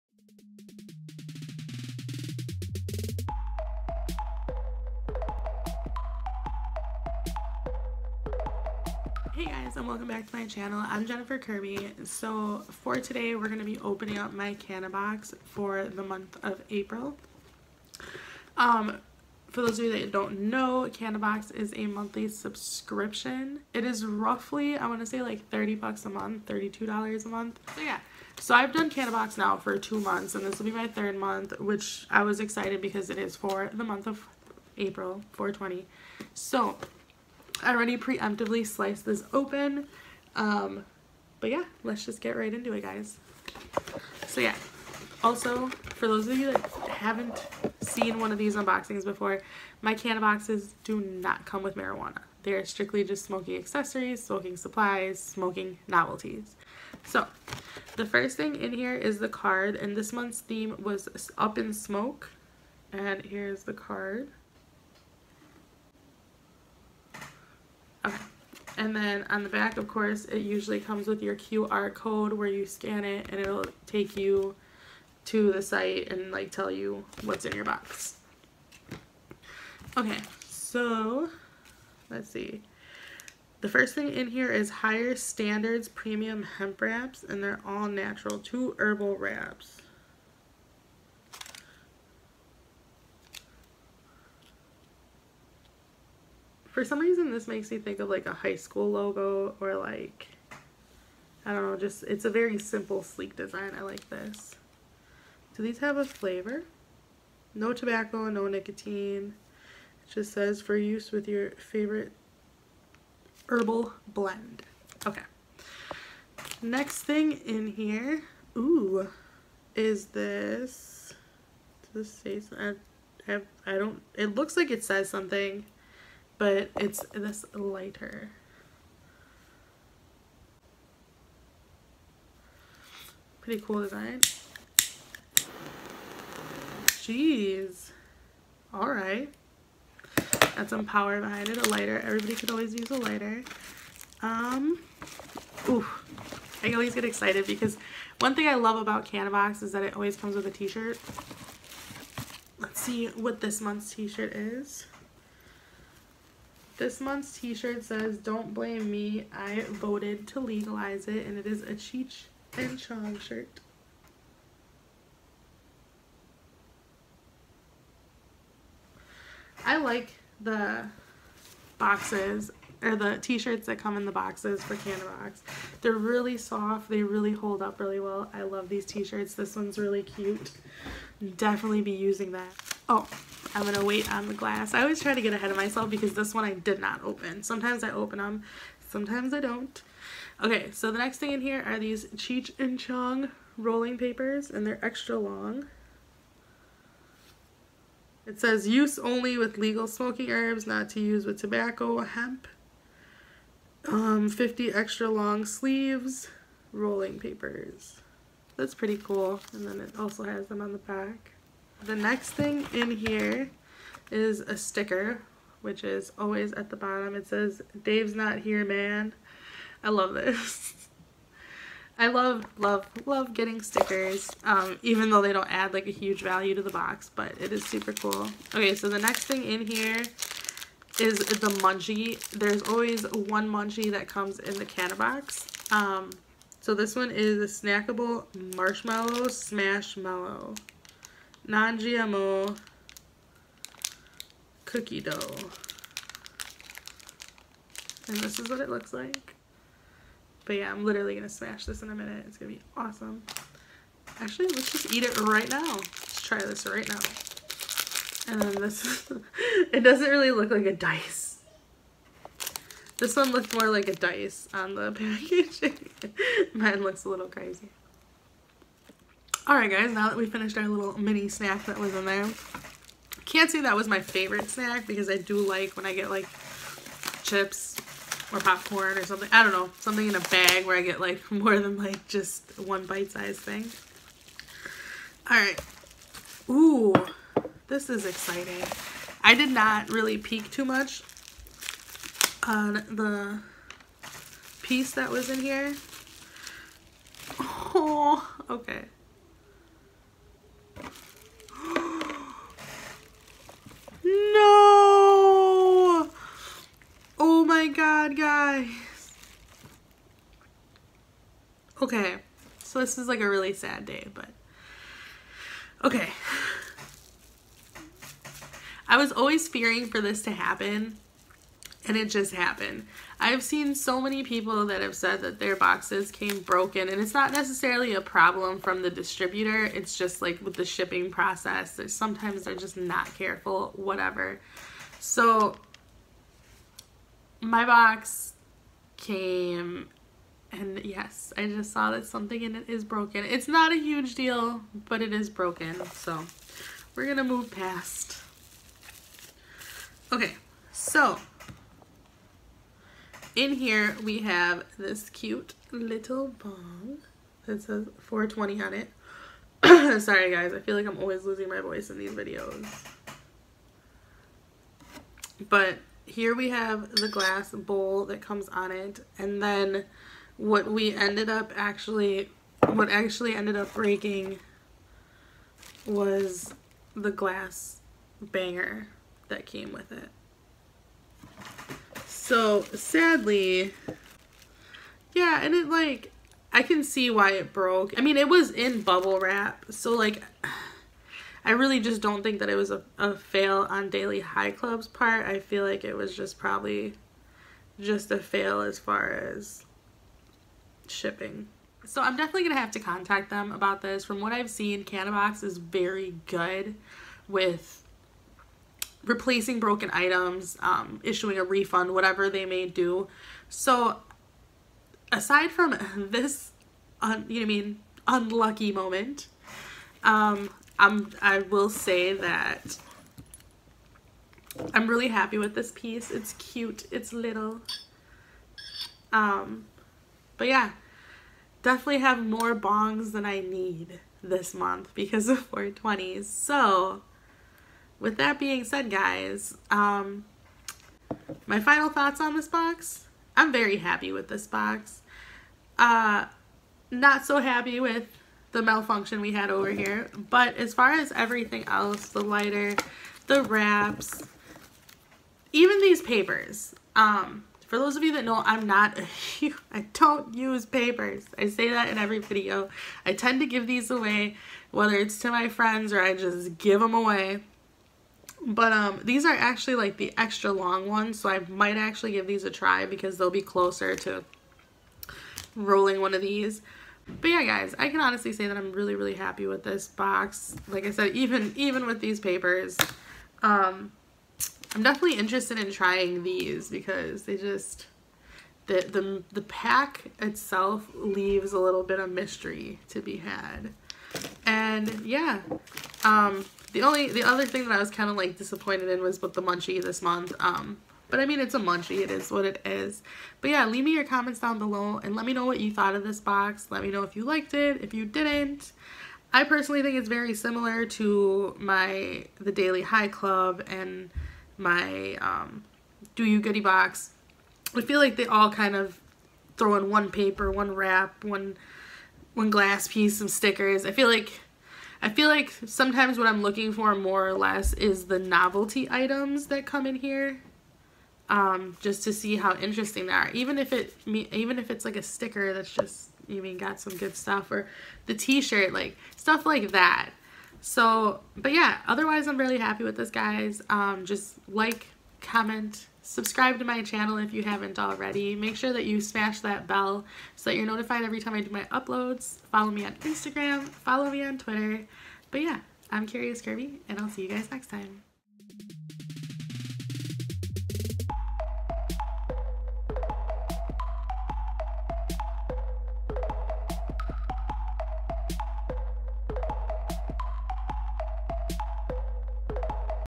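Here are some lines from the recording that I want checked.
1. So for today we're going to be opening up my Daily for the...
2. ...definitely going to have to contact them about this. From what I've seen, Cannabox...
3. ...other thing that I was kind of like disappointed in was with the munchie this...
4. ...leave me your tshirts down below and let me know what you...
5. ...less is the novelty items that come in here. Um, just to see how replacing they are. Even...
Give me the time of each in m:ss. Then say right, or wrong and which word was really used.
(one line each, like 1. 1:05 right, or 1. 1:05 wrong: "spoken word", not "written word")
1. 0:12 wrong: "Cannabox", not "Daily"
2. 6:42 right
3. 8:17 right
4. 8:23 wrong: "comments", not "tshirts"
5. 8:47 wrong: "interesting", not "replacing".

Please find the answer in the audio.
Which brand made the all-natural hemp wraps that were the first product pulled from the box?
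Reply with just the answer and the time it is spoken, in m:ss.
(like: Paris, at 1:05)
Higher Standards, at 1:24.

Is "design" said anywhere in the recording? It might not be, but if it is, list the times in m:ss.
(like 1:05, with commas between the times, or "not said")
1:43, 2:13.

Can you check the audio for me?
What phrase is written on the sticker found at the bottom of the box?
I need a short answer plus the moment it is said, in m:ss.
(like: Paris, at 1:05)
Dave's not here, man, at 3:37.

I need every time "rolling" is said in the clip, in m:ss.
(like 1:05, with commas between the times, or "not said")
3:13, 3:26, 7:55.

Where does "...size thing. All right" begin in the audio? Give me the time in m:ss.
4:43.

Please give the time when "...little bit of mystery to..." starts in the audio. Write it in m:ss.
8:11.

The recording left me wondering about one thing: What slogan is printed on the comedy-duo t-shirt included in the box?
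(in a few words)
Don't blame me, I voted to legalize it.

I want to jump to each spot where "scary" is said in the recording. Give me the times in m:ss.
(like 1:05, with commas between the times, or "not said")
not said.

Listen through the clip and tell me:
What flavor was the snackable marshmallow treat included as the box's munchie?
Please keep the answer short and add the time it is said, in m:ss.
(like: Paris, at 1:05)
Cookie dough, at 4:04.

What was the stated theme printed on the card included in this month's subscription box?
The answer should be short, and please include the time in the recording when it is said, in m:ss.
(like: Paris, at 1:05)
Up in Smoke, at 1:01.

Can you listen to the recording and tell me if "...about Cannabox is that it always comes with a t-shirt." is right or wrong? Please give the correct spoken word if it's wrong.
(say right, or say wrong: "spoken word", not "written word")
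right.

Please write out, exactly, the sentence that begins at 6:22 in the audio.
So sadly, yeah, and it like, I can see why it broke.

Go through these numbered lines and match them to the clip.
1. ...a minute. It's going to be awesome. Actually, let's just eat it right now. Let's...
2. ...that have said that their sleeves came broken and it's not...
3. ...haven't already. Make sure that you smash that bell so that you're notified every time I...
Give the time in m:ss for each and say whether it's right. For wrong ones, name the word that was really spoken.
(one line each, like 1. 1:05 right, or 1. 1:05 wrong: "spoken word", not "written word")
1. 4:11 right
2. 5:24 wrong: "boxes", not "sleeves"
3. 9:07 right.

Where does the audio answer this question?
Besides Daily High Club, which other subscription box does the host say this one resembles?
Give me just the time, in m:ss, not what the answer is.
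8:36.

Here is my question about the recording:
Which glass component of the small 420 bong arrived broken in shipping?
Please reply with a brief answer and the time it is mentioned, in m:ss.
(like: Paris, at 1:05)
Glass banger, at 6:17.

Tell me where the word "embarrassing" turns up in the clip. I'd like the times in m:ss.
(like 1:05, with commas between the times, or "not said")
not said.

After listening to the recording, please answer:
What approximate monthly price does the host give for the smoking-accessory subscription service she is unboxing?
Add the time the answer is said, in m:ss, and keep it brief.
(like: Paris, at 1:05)
$32, at 0:26.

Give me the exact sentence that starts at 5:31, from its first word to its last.
sometimes they're just not careful, whatever.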